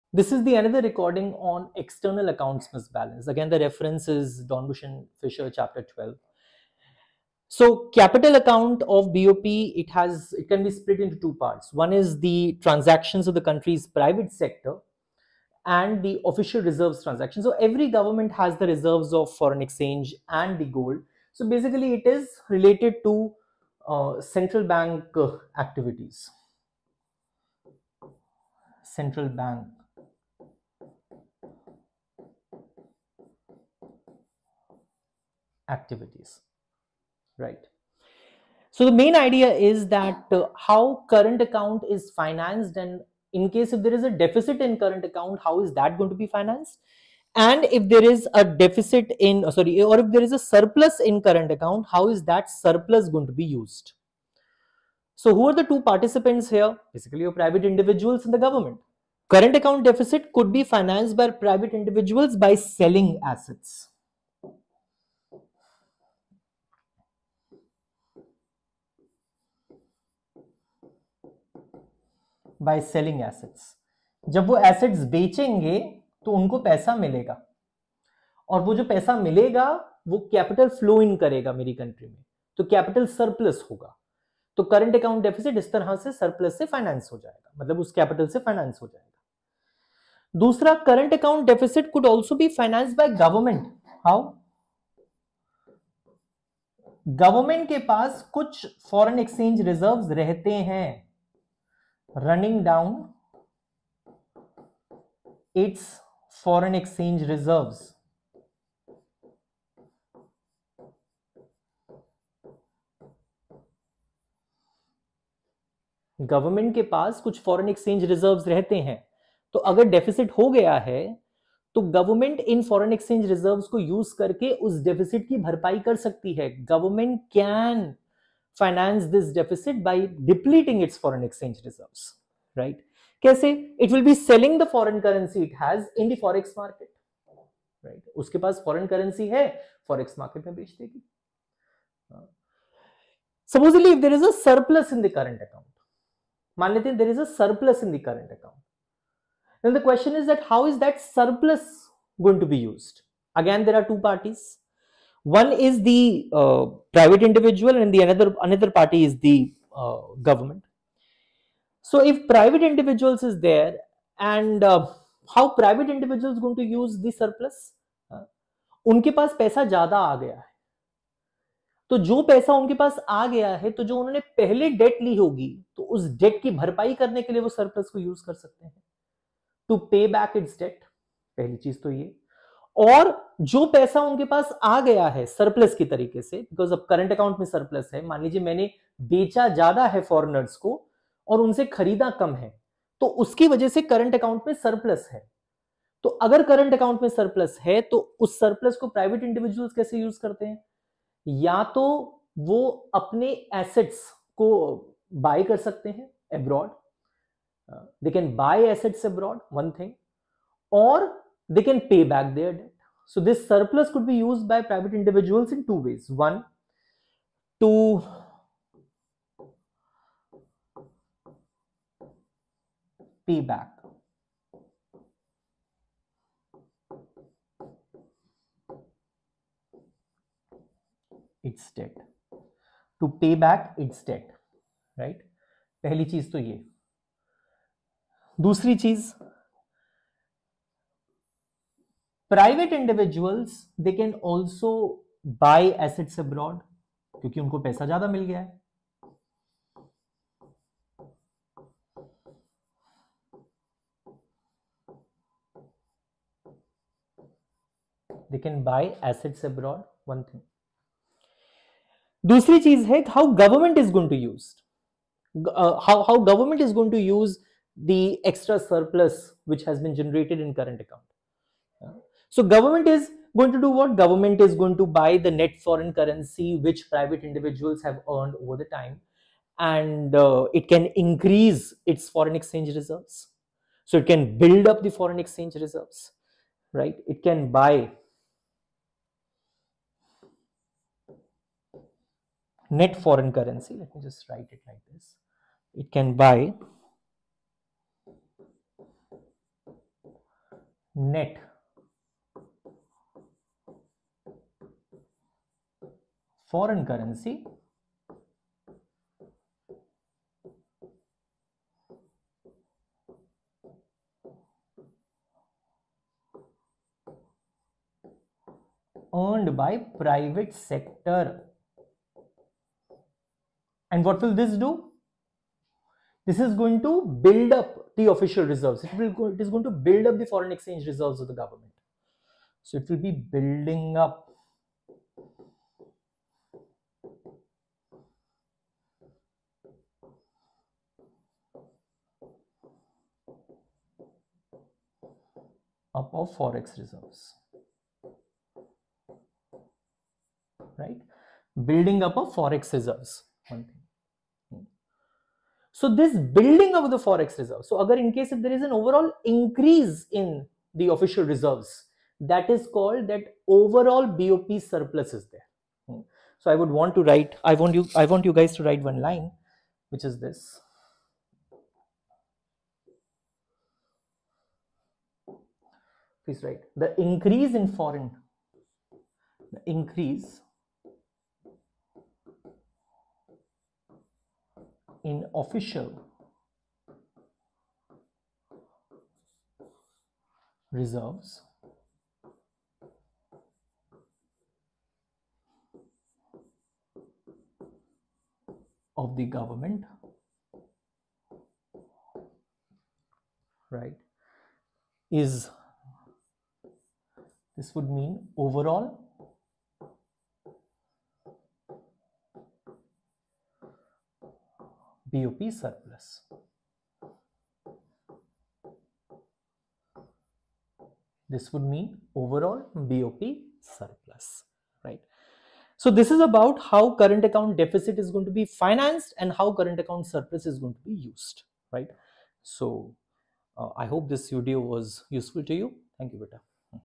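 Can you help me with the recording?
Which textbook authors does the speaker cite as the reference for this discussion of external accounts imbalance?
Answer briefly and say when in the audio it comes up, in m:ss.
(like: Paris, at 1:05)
Dornbusch and Fisher, at 0:04.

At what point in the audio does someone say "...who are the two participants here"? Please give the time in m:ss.
0:55.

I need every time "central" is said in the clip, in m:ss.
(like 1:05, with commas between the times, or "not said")
0:24, 0:28.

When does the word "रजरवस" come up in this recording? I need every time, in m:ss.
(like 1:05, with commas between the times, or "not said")
1:39, 1:58, 2:03.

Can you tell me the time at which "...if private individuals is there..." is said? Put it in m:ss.
2:42.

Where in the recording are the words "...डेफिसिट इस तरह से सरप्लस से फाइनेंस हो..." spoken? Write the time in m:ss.
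1:25.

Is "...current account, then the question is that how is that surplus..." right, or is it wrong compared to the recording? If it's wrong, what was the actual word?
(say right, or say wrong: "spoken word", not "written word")
right.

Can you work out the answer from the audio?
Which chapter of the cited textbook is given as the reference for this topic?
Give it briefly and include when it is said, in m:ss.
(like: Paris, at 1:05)
Chapter 12, at 0:05.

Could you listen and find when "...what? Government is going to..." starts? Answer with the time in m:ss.
4:33.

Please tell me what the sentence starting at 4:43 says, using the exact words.
So it can build up the foreign exchange reserves, right?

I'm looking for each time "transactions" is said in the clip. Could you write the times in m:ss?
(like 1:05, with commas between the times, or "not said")
0:12, 0:17.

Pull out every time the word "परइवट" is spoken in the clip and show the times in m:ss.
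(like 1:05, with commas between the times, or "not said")
3:18, 4:02.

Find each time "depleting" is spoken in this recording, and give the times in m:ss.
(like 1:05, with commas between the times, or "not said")
2:10.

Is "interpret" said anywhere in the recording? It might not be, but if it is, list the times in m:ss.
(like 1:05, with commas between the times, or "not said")
not said.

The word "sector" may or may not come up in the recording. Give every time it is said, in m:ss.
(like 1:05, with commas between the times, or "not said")
0:14, 5:20.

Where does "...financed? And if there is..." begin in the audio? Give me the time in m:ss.
0:46.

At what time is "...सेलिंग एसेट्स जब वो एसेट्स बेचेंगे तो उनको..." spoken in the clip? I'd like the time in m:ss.
1:12.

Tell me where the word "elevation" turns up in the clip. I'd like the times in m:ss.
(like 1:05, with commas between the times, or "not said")
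not said.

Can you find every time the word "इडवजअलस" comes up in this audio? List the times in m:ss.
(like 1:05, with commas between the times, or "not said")
3:19, 4:02.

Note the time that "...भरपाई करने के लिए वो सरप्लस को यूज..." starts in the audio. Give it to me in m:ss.
2:56.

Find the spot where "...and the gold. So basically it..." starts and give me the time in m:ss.
0:20.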